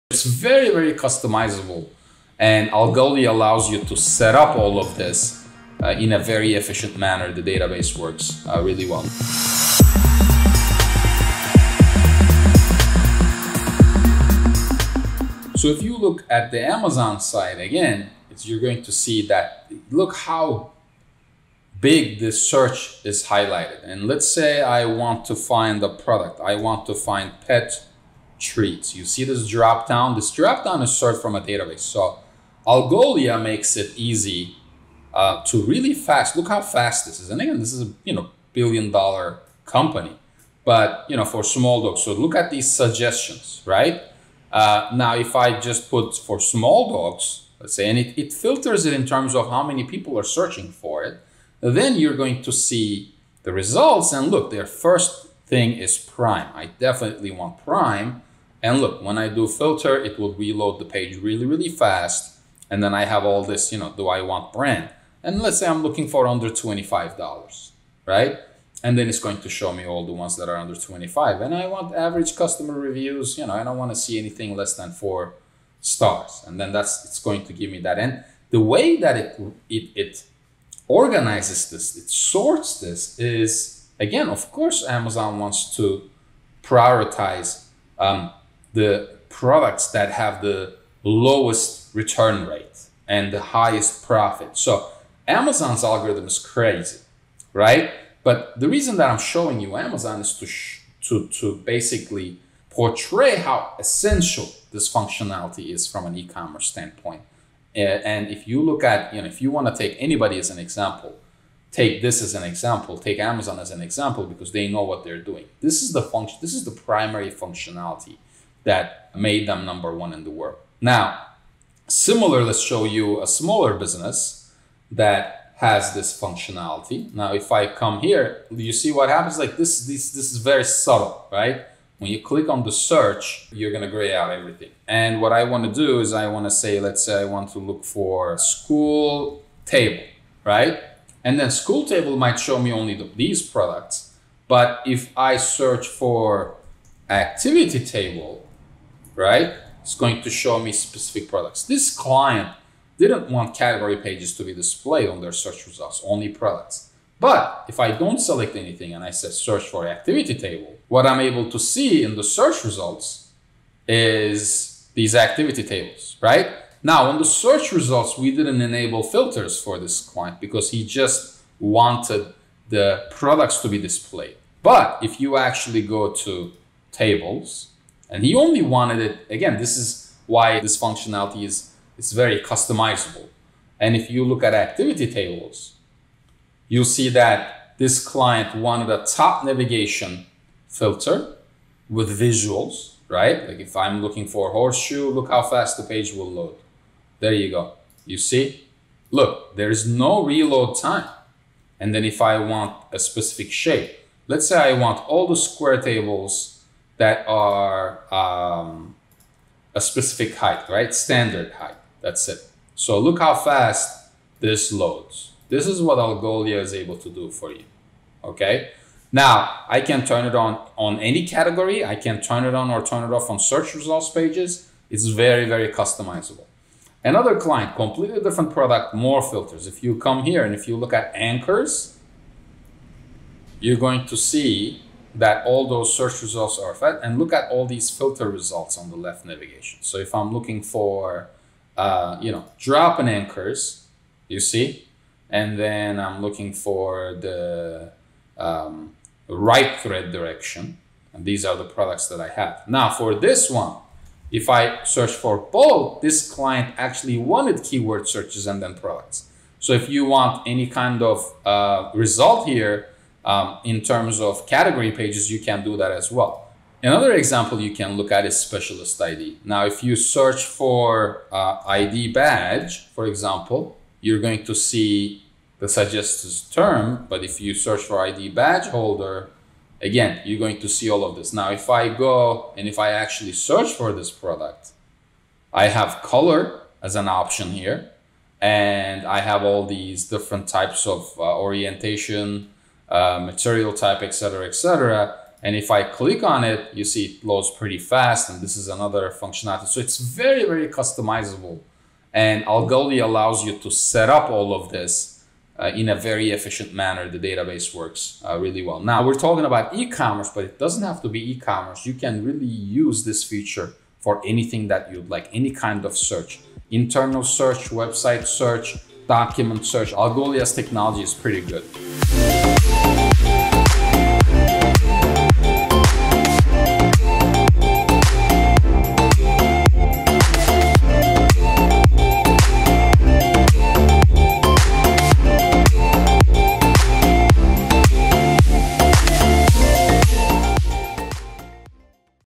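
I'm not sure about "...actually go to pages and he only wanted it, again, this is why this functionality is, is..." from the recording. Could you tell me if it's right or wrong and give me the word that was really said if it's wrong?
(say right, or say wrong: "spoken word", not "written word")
wrong: "tables", not "pages".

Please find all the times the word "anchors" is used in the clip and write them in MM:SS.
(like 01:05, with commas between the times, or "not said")
03:51, 04:03.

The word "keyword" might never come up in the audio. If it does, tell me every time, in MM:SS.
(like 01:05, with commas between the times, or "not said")
04:17.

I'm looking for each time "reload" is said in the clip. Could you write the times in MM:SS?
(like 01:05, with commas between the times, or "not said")
01:00, 03:20.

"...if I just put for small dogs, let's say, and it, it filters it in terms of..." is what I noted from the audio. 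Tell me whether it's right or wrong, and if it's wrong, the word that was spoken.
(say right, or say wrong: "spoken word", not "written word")
right.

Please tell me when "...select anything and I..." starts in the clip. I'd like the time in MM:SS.
02:38.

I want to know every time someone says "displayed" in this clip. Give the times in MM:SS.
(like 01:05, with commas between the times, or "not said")
02:34, 02:53.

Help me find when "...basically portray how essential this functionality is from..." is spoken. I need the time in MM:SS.
01:41.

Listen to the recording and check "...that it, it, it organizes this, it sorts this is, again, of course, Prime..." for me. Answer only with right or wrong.
wrong.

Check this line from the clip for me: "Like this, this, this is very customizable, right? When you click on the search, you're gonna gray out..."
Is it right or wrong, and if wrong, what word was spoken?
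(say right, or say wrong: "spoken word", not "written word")
wrong: "subtle", not "customizable".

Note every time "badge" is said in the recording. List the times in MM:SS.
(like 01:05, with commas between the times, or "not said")
04:32, 04:38.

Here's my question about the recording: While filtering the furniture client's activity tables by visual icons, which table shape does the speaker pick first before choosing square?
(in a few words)
horseshoe.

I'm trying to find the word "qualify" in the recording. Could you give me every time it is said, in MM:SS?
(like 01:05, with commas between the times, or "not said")
not said.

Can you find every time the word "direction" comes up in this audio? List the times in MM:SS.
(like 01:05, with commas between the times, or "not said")
04:10.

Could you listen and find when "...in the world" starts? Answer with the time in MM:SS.
02:00.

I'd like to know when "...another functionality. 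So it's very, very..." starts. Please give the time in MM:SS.
04:58.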